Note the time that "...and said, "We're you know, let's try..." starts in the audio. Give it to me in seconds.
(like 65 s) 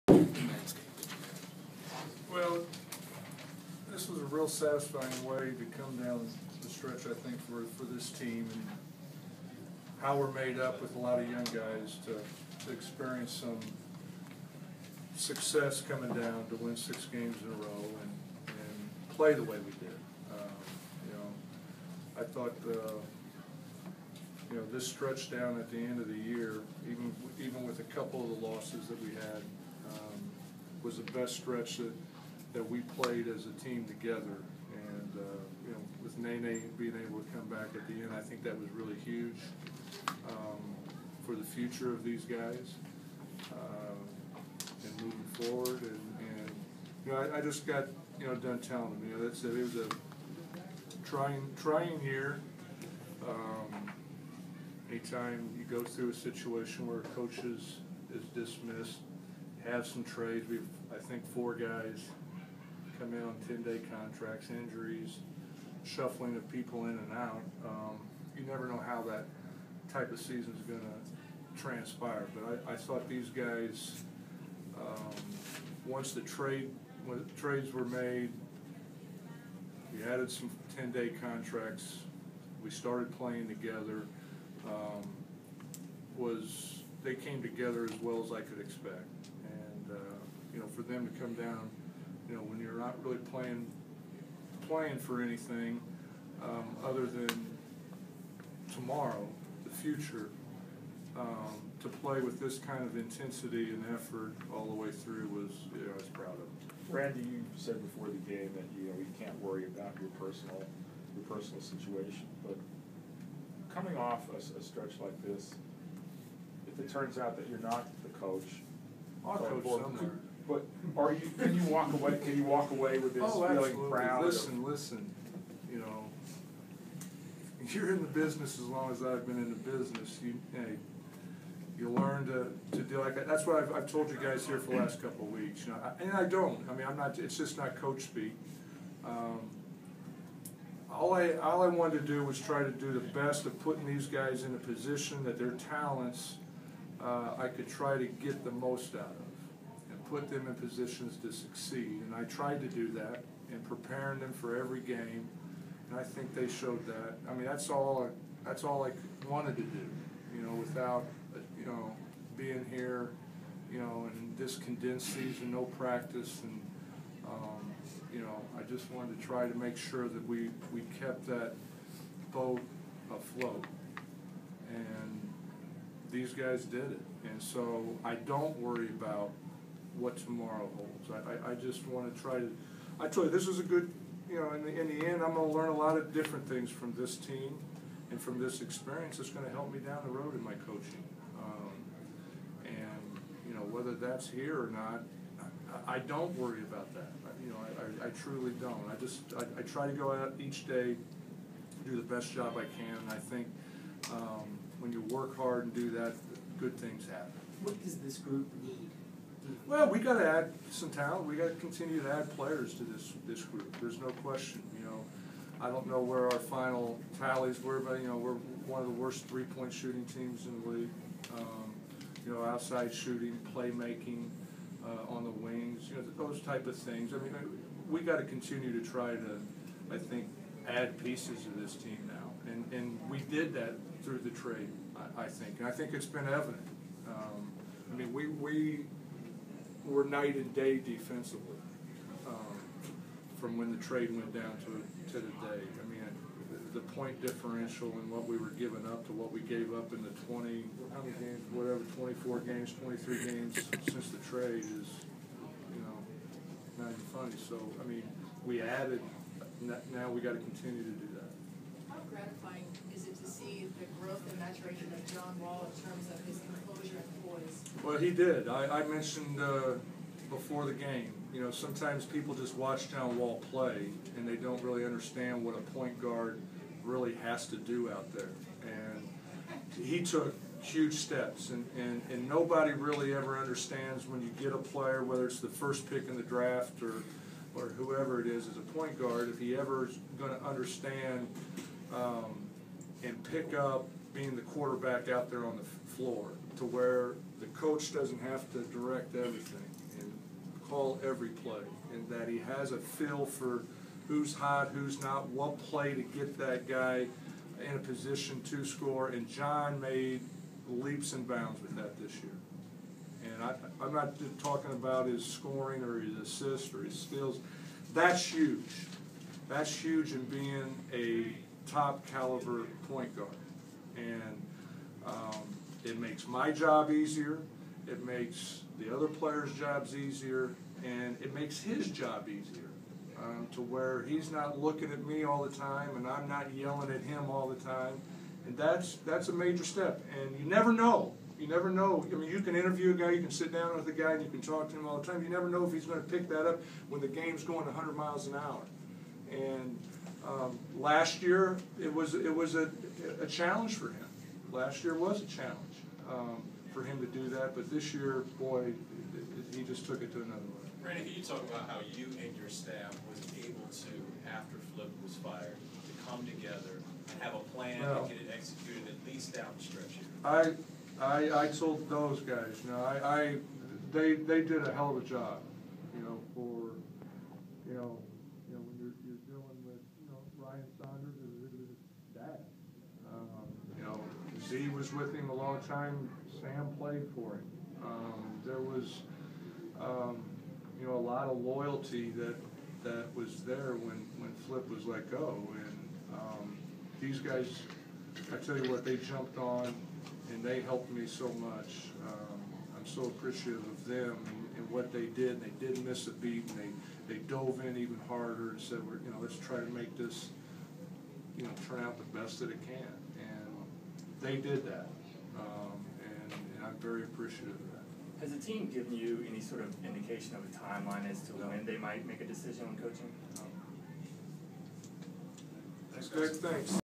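408 s.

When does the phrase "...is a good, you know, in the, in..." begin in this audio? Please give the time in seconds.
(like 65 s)
183 s.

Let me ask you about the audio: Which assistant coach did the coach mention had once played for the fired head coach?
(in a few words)
Sam.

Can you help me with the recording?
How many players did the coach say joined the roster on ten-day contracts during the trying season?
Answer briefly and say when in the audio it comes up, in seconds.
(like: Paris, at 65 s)
4, at 61 s.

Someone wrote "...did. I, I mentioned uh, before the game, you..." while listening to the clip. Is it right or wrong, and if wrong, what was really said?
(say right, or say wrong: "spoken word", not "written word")
right.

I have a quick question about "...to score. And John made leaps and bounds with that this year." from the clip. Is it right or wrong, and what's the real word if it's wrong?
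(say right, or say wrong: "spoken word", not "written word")
right.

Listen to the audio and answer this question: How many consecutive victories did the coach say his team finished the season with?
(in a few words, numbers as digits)
6.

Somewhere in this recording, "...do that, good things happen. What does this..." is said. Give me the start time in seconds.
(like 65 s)
205 s.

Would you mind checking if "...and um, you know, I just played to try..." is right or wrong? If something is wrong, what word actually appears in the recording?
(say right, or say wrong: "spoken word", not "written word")
wrong: "wanted", not "played".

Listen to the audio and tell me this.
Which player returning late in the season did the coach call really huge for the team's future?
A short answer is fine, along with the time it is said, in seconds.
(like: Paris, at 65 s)
Nene, at 36 s.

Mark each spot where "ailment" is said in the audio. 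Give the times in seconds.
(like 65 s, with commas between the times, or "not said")
not said.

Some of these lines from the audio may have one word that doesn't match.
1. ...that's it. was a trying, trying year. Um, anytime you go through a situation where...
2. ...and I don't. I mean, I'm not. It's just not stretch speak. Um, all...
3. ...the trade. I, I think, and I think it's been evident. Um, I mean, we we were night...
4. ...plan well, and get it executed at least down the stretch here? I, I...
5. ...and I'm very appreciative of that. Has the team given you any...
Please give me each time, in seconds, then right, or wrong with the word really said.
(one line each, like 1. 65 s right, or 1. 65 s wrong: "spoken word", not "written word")
1. 49 s right
2. 136 s wrong: "coach", not "stretch"
3. 234 s right
4. 367 s right
5. 416 s right.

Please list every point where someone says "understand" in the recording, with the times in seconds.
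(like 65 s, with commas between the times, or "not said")
274 s, 283 s, 290 s.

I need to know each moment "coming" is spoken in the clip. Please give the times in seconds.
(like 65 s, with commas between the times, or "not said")
15 s, 113 s.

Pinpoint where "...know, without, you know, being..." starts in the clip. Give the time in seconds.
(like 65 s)
160 s.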